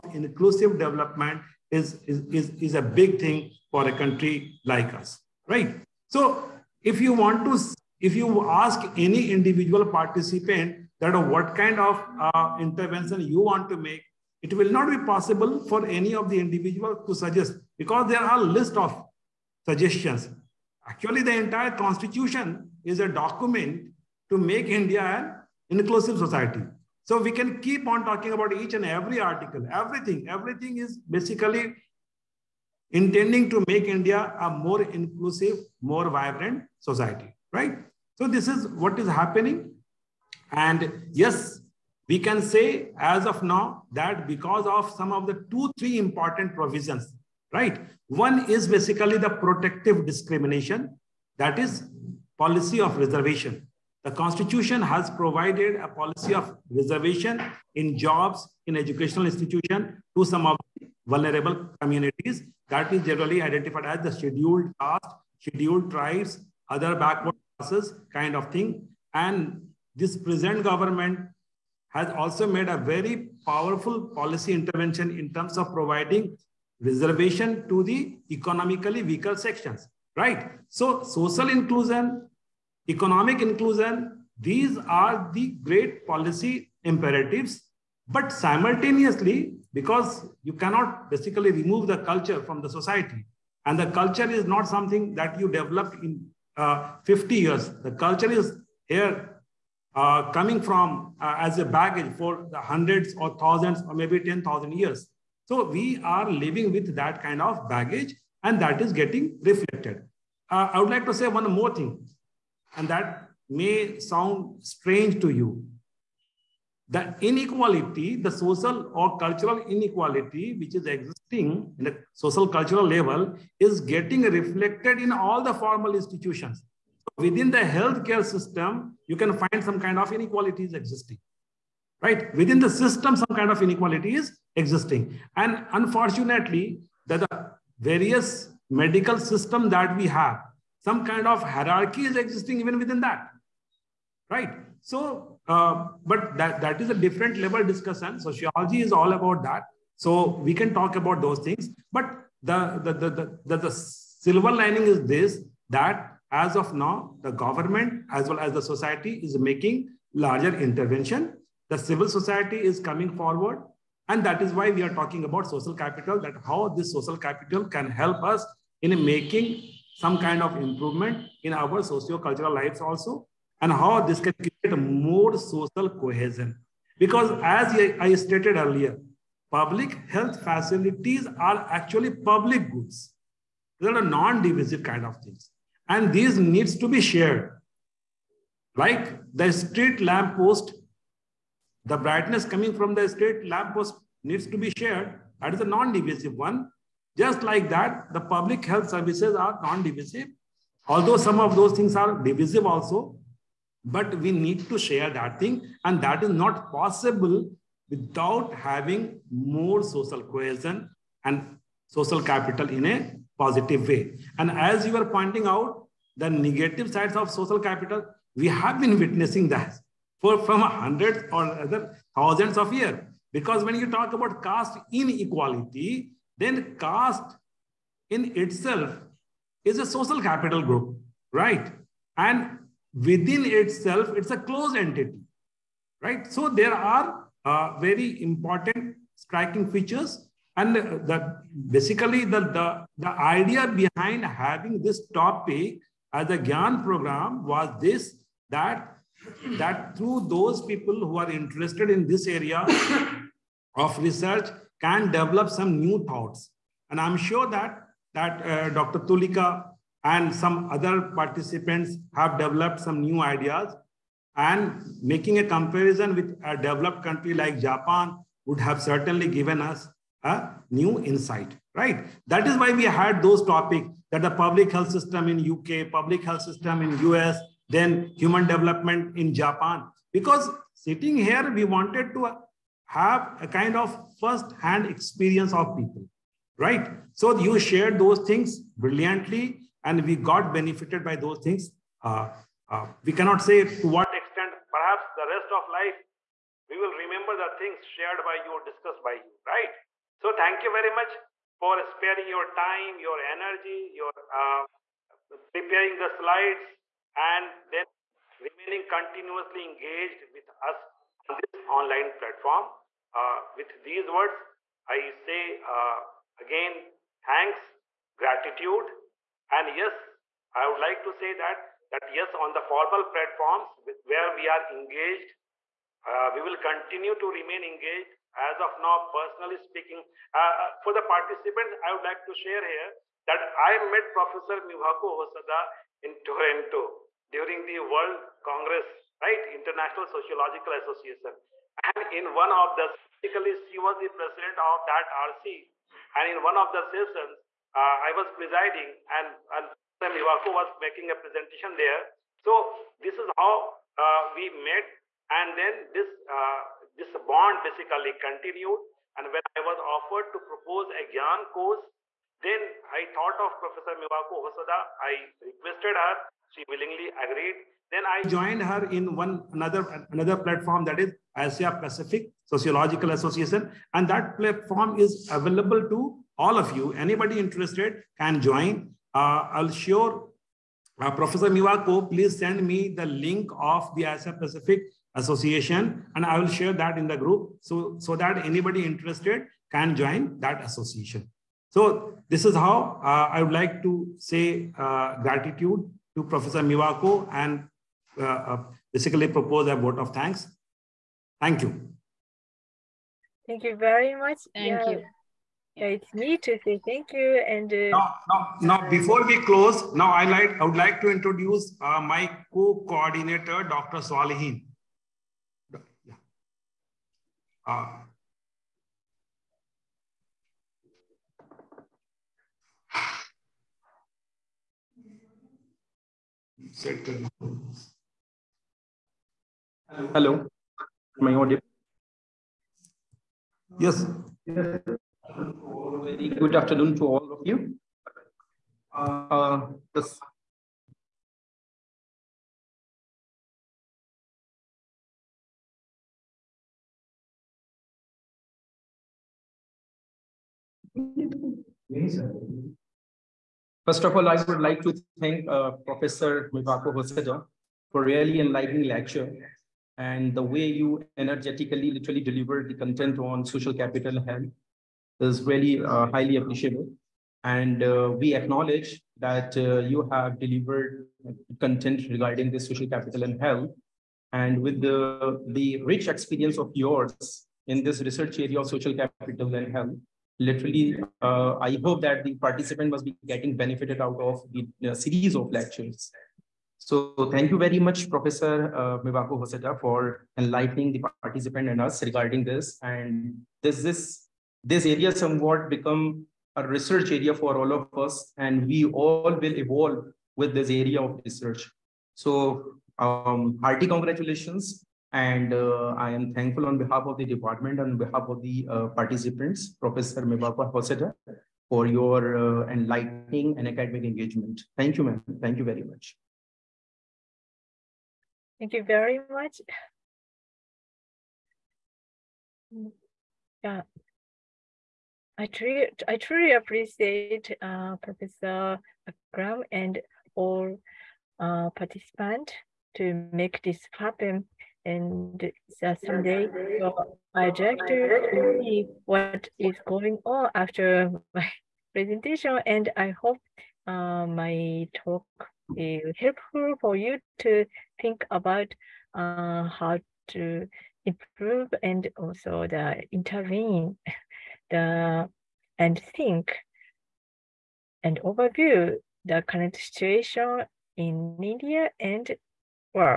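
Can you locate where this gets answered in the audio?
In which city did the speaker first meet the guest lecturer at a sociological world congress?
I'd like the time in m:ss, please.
5:36.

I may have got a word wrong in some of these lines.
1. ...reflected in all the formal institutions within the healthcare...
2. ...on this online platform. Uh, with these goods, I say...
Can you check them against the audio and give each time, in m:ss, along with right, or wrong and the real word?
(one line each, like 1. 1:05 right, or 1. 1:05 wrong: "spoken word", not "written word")
1. 2:04 right
2. 5:11 wrong: "words", not "goods".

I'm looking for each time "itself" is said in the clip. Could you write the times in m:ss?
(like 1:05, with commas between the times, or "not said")
3:48, 3:53.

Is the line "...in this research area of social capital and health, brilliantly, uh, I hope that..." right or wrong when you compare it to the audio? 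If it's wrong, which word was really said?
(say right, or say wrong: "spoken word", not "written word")
wrong: "literally", not "brilliantly".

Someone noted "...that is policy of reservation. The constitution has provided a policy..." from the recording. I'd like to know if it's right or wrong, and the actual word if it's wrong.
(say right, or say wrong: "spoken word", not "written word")
right.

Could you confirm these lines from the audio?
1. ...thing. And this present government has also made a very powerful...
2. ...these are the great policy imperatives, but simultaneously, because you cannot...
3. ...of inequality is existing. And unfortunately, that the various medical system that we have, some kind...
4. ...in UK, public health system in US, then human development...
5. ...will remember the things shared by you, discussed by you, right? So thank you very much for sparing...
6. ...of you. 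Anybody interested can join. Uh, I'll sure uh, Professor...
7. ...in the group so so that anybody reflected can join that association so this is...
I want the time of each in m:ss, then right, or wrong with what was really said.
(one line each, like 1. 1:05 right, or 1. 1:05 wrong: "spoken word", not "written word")
1. 1:08 right
2. 1:24 right
3. 2:13 right
4. 4:35 right
5. 4:56 right
6. 6:16 right
7. 6:26 wrong: "interested", not "reflected".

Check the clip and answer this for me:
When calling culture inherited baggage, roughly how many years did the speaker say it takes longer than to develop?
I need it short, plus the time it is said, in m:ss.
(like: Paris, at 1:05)
50, at 1:37.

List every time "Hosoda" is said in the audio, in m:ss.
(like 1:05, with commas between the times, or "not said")
5:35, 6:04, 7:36, 8:30.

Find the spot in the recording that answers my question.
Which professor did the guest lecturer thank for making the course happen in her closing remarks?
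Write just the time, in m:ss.
8:48.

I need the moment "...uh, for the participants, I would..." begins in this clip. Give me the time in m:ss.
5:30.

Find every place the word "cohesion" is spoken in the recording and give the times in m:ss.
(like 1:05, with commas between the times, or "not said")
2:55, 3:30.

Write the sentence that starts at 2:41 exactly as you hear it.
The civil society is coming forward.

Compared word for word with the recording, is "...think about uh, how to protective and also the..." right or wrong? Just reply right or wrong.
wrong.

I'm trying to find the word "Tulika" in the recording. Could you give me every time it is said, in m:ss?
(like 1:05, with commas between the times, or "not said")
4:19.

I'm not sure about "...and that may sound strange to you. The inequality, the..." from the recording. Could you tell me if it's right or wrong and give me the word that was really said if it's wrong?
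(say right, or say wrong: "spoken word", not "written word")
right.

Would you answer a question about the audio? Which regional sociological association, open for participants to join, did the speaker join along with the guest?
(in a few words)
Asia Pacific Sociological Association.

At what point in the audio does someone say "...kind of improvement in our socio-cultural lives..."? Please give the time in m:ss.
2:50.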